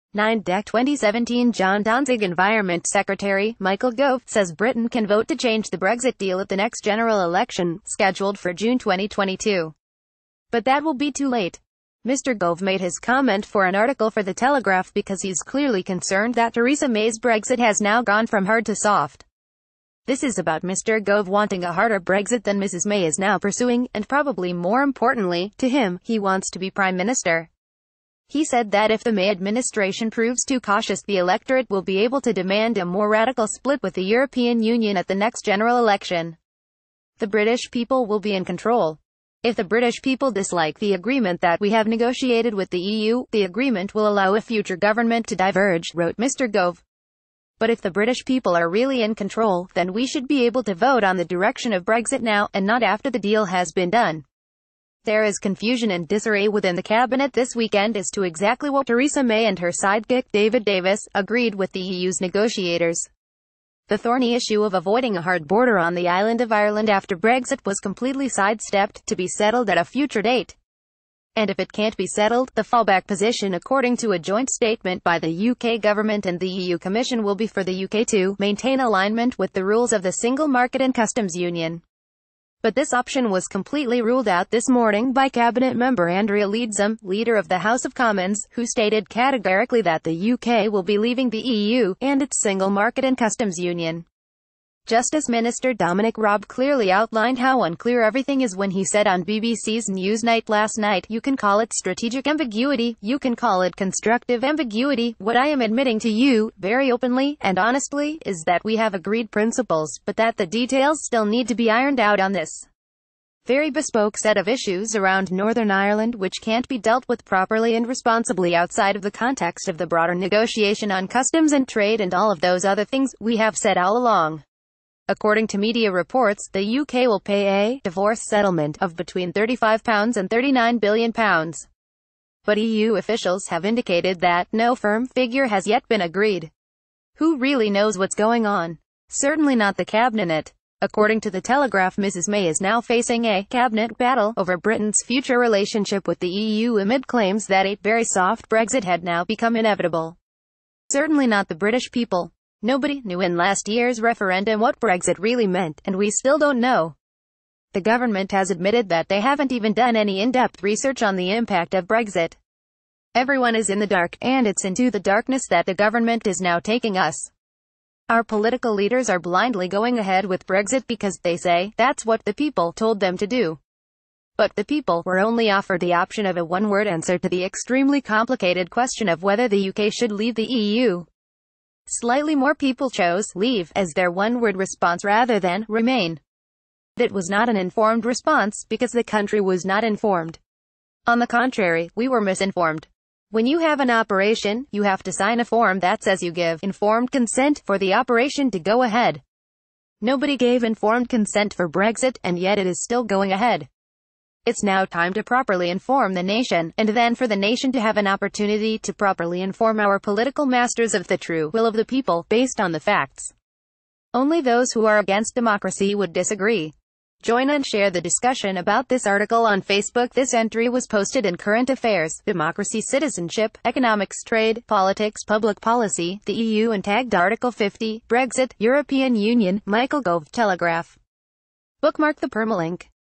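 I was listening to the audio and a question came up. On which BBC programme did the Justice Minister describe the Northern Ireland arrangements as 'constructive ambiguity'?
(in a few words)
Newsnight.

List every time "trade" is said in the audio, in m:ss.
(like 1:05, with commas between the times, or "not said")
2:01, 3:44.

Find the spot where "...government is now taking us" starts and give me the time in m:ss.
2:45.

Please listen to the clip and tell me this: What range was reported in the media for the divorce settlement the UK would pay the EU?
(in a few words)
£35 to £39 billion.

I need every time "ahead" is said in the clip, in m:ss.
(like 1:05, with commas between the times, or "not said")
2:49, 3:18, 3:23.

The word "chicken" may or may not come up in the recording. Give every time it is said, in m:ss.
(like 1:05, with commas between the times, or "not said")
not said.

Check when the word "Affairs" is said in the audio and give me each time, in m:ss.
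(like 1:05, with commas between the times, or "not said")
3:41.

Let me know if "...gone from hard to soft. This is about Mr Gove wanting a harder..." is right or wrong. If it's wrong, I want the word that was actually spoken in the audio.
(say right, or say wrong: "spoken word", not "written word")
right.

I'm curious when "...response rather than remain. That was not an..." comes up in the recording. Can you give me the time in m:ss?
3:04.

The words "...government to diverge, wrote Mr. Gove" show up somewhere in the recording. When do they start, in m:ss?
0:44.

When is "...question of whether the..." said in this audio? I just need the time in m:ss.
2:58.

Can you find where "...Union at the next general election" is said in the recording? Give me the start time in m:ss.
0:34.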